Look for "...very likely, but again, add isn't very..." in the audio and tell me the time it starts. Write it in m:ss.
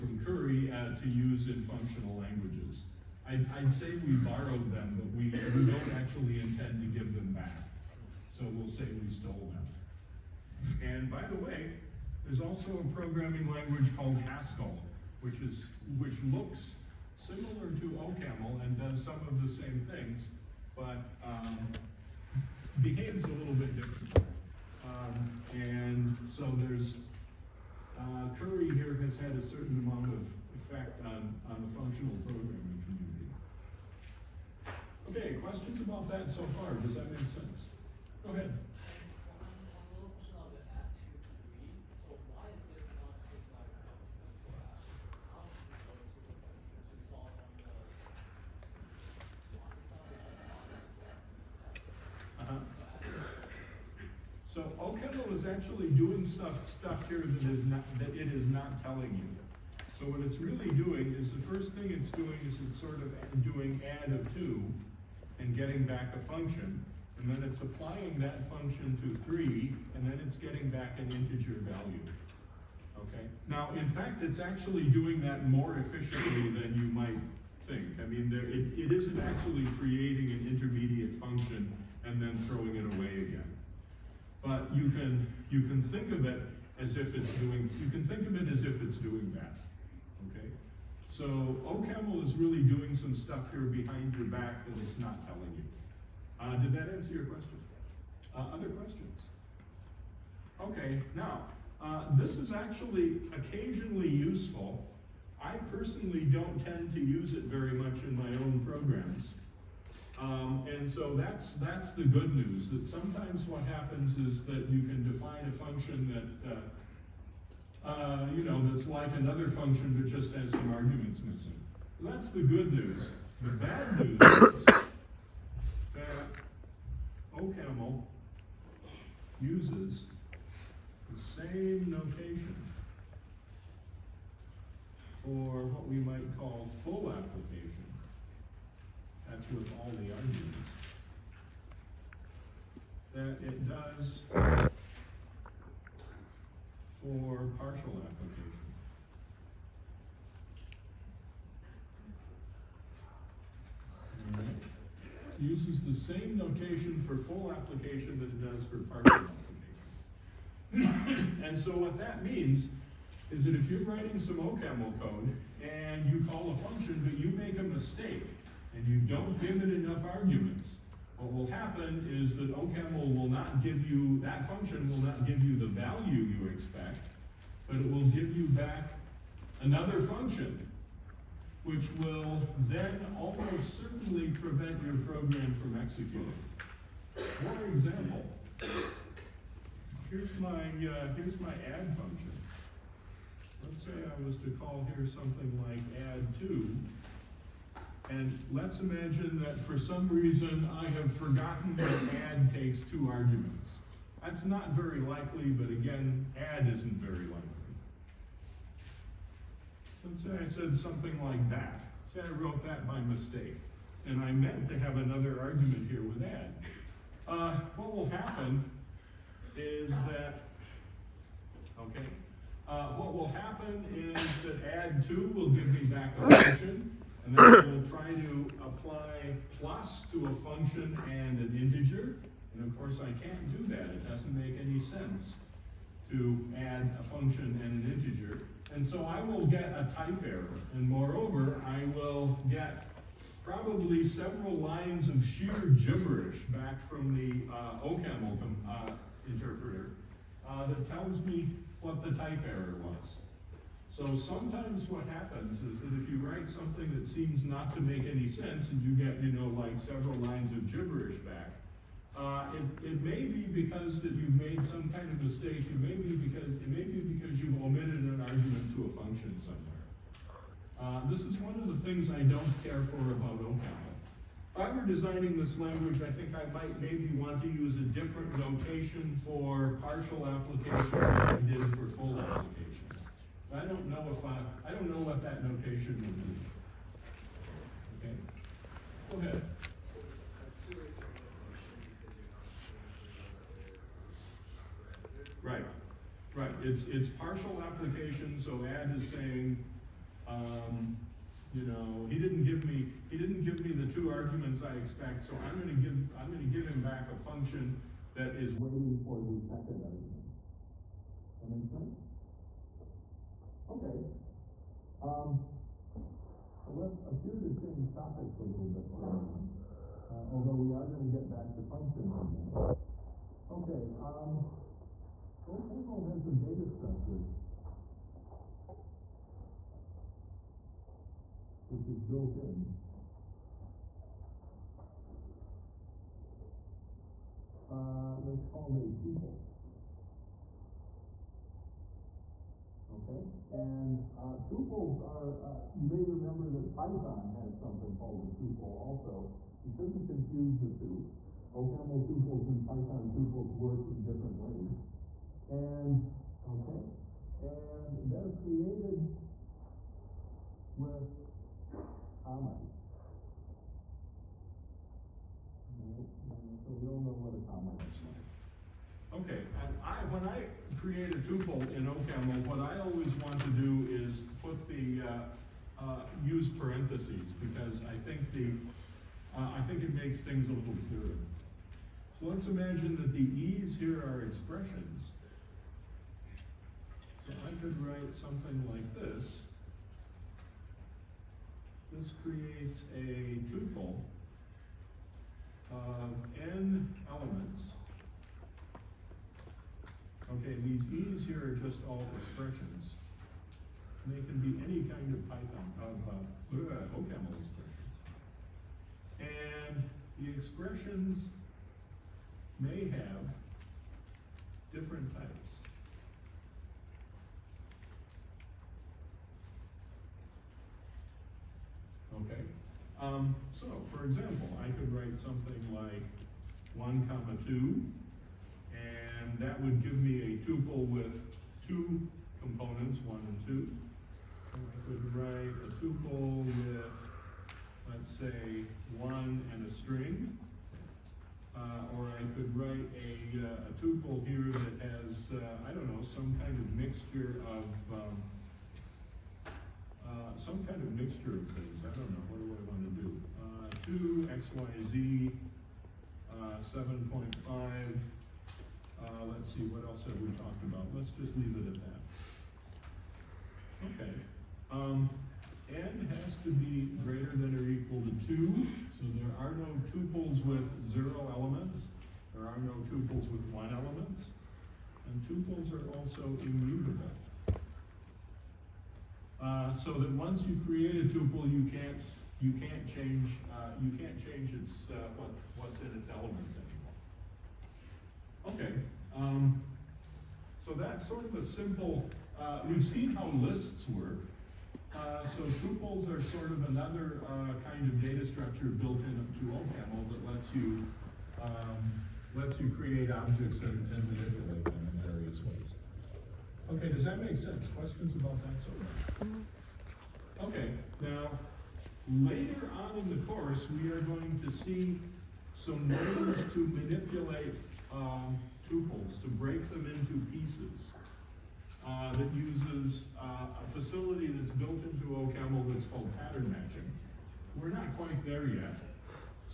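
3:24.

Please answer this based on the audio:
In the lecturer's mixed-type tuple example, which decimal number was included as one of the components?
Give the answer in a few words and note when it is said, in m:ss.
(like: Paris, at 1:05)
7.5, at 7:37.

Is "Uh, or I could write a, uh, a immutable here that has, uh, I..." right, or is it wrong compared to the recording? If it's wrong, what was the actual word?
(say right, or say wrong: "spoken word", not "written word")
wrong: "tuple", not "immutable".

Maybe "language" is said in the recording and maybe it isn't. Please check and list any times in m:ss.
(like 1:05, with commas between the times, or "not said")
0:02, 0:13, 4:35.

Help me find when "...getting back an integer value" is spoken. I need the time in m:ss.
1:10.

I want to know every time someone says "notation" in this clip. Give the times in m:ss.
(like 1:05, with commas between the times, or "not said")
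2:11, 2:36, 4:38, 4:45.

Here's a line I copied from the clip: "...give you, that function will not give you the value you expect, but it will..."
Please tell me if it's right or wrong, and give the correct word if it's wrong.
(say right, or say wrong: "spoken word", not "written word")
right.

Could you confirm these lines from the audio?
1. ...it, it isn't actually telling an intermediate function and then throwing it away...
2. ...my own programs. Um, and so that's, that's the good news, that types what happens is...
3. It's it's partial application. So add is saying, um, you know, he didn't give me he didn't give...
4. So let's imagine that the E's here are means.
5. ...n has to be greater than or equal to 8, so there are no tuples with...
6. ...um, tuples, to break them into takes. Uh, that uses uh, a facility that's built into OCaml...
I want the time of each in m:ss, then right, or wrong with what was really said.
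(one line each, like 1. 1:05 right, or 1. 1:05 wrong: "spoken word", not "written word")
1. 1:18 wrong: "creating", not "telling"
2. 1:48 wrong: "sometimes", not "types"
3. 4:56 right
4. 6:22 wrong: "expressions", not "means"
5. 7:45 wrong: "2", not "8"
6. 8:37 wrong: "pieces", not "takes".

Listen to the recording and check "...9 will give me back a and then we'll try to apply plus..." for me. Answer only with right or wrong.
wrong.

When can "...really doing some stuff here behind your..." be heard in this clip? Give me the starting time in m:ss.
1:32.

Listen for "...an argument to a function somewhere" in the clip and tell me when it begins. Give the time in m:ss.
4:28.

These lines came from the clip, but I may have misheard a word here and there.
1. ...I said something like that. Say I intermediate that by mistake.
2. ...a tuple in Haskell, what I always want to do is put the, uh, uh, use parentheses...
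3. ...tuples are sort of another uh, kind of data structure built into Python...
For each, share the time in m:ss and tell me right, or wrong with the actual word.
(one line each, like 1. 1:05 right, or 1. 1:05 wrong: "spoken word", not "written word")
1. 3:30 wrong: "wrote", not "intermediate"
2. 6:11 wrong: "OCaml", not "Haskell"
3. 8:15 wrong: "OCaml", not "Python".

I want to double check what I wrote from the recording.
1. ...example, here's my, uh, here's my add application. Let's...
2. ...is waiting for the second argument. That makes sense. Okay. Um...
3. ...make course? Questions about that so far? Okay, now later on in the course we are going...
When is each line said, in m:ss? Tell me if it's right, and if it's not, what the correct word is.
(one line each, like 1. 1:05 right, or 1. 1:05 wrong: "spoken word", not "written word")
1. 3:07 wrong: "function", not "application"
2. 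5:08 right
3. 8:27 wrong: "sense", not "course".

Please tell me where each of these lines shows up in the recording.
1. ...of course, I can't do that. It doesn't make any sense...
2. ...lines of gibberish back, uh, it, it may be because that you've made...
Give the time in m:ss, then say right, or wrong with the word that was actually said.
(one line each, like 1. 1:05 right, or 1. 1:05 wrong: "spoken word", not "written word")
1. 3:52 right
2. 4:20 right.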